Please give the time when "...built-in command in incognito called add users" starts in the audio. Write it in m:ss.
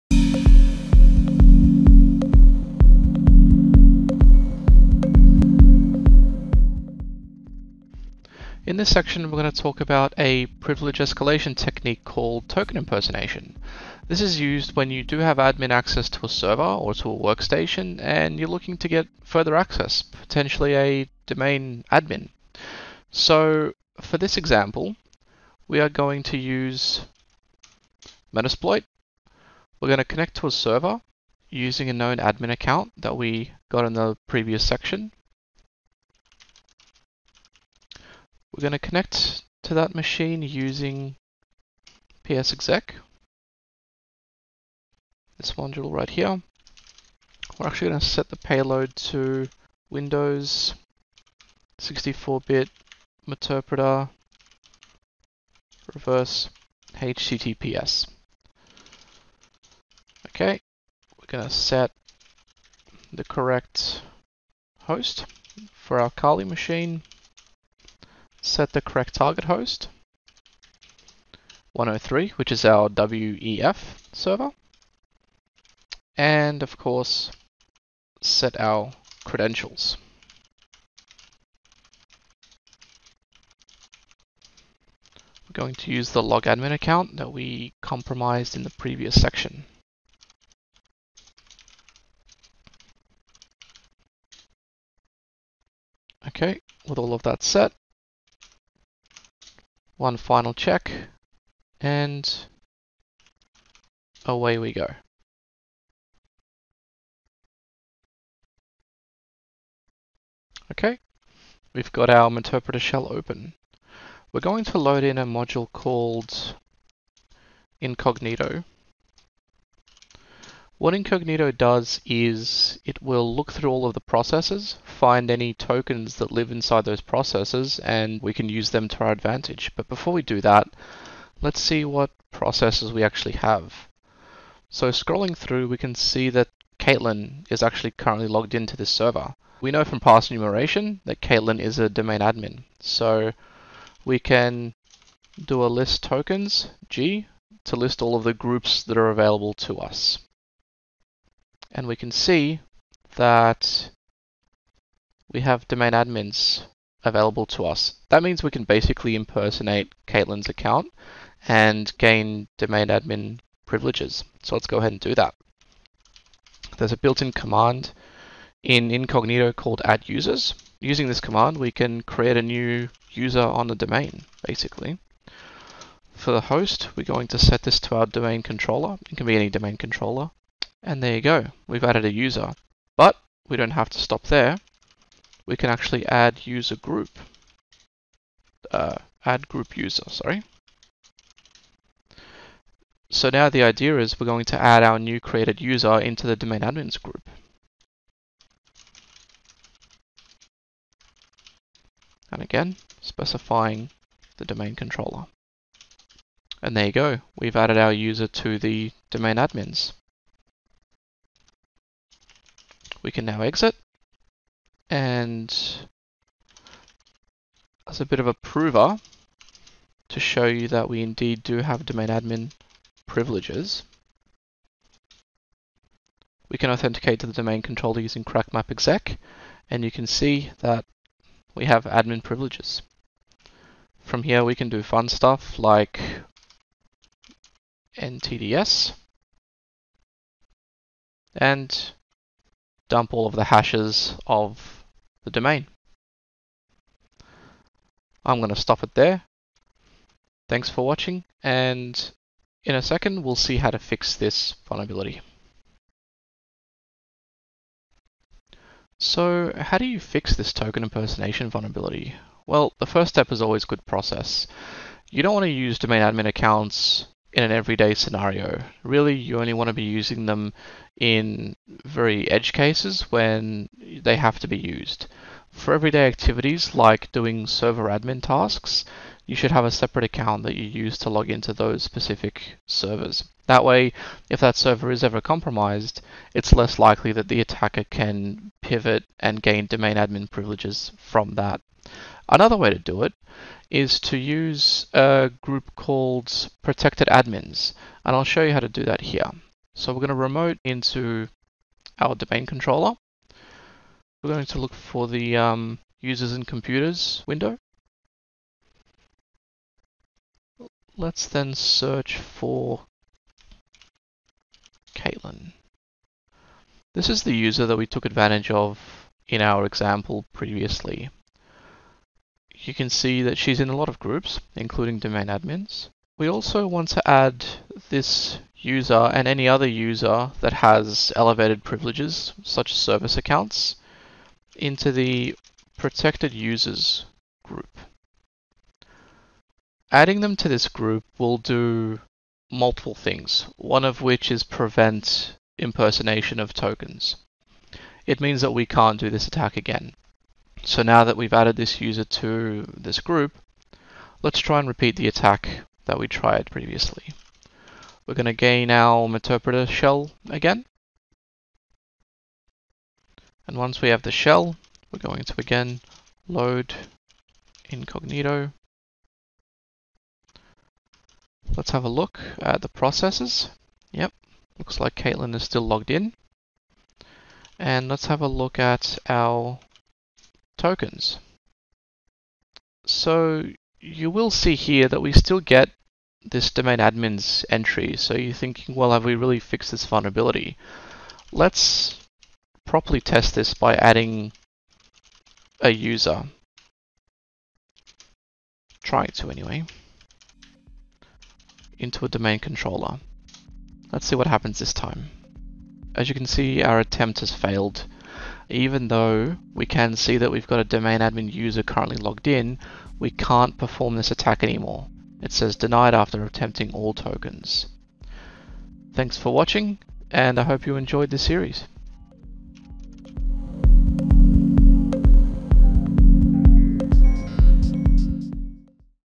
2:46.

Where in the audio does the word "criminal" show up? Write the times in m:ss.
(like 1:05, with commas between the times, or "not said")
not said.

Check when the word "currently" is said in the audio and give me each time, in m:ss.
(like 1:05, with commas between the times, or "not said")
2:17, 6:51.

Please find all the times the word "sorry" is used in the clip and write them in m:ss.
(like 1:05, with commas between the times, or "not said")
3:10.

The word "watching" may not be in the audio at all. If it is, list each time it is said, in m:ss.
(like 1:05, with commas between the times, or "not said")
4:10, 6:59.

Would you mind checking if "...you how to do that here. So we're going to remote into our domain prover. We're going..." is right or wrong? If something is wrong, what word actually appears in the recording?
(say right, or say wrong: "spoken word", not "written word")
wrong: "controller", not "prover".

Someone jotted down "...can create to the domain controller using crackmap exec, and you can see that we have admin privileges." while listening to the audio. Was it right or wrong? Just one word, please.
wrong.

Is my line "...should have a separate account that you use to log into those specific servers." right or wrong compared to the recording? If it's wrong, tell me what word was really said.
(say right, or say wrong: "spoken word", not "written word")
right.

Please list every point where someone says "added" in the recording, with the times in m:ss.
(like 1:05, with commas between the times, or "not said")
3:01, 3:27, 5:51.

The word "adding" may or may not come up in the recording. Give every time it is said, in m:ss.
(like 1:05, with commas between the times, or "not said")
5:39, 6:33.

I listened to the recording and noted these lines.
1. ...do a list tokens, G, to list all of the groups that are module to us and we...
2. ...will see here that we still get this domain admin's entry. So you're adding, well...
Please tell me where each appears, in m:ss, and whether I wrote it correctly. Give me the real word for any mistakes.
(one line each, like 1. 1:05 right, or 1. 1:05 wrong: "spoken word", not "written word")
1. 2:25 wrong: "available", not "module"
2. 6:24 wrong: "thinking", not "adding".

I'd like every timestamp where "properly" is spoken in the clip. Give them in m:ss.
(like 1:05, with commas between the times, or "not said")
6:32.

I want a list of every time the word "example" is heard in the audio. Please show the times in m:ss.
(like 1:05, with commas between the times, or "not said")
0:24, 5:19.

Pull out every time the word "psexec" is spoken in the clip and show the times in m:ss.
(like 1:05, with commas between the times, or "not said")
0:42.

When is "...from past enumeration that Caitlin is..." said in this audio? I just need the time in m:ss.
2:19.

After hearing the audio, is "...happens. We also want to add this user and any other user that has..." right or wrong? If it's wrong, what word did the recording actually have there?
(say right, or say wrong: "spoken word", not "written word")
wrong: "admins", not "happens".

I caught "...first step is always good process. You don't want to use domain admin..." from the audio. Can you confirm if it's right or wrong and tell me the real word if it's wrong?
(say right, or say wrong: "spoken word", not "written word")
right.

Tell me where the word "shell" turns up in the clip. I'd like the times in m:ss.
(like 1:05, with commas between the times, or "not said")
1:52, 5:59, 6:04.